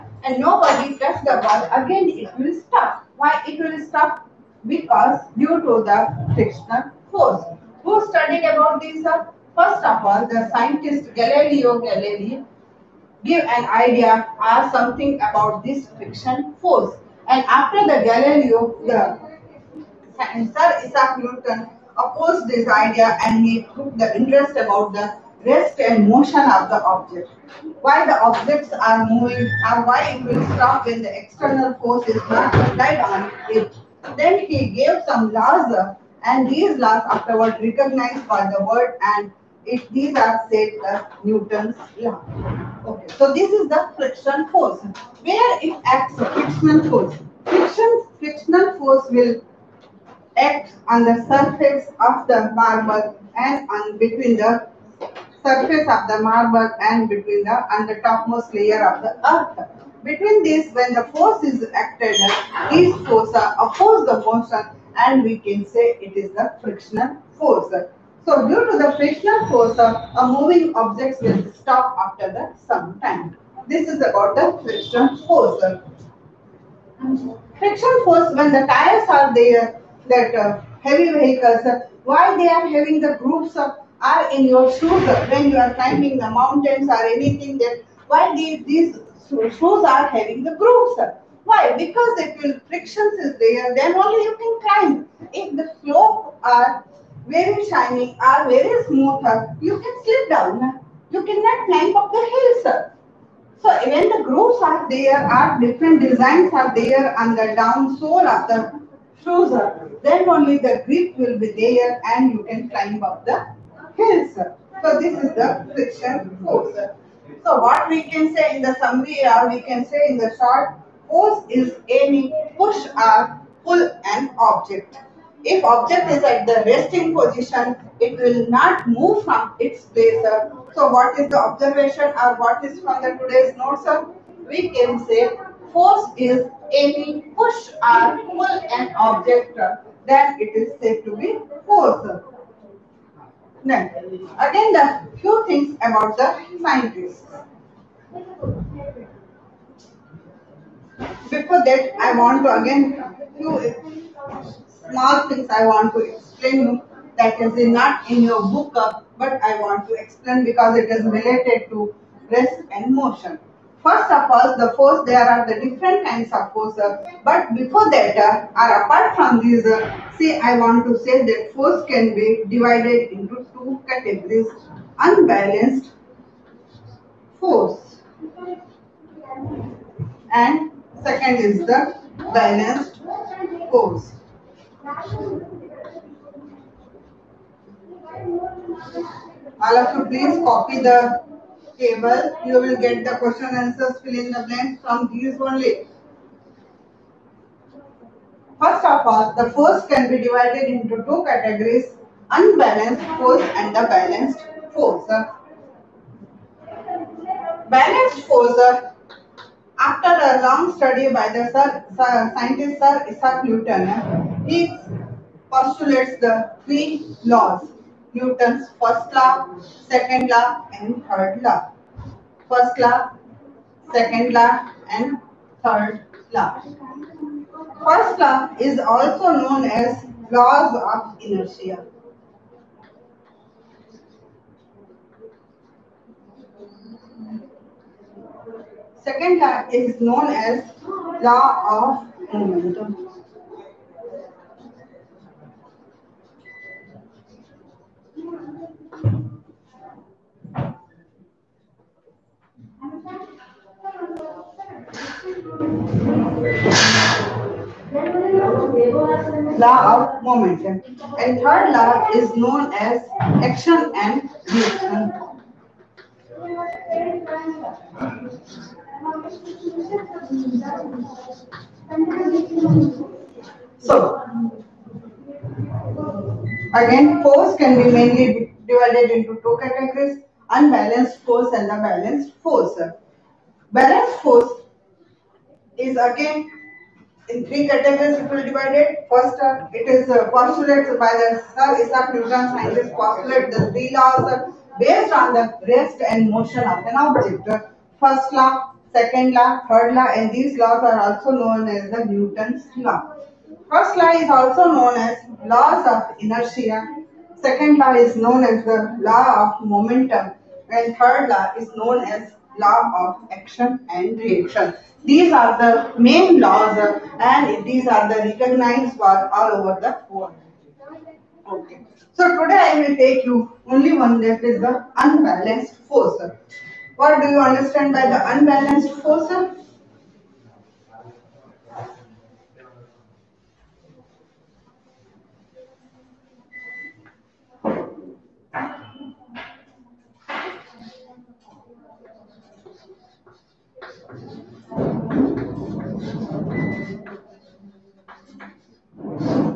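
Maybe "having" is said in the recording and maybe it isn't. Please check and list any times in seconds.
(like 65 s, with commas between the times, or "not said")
82 s, 90 s.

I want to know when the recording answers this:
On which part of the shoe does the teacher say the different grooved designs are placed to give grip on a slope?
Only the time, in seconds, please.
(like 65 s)
107 s.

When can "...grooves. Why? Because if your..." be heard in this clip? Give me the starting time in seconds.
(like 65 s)
90 s.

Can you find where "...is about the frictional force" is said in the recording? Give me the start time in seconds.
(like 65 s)
73 s.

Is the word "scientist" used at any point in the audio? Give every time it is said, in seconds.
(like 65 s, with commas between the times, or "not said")
10 s, 146 s, 212 s, 292 s.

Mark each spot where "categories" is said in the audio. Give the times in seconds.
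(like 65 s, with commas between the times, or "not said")
173 s, 201 s, 279 s, 287 s.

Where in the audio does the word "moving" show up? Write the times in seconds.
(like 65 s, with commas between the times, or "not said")
29 s, 70 s.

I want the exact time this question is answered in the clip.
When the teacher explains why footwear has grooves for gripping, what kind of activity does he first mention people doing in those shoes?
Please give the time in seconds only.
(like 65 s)
85 s.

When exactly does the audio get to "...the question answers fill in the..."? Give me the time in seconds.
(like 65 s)
193 s.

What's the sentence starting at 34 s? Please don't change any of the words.
Then he gave some laws and these laws afterward recognized by the world and if these are said as Newton's law.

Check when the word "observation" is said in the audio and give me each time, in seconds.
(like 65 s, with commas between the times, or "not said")
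131 s.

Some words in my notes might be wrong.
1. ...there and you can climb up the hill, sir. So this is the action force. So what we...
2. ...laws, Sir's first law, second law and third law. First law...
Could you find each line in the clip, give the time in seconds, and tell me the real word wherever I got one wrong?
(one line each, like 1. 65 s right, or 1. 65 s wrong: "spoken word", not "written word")
1. 111 s wrong: "friction", not "action"
2. 217 s wrong: "Newton", not "Sir".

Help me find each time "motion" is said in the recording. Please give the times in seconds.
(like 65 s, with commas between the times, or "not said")
26 s, 64 s, 162 s, 296 s.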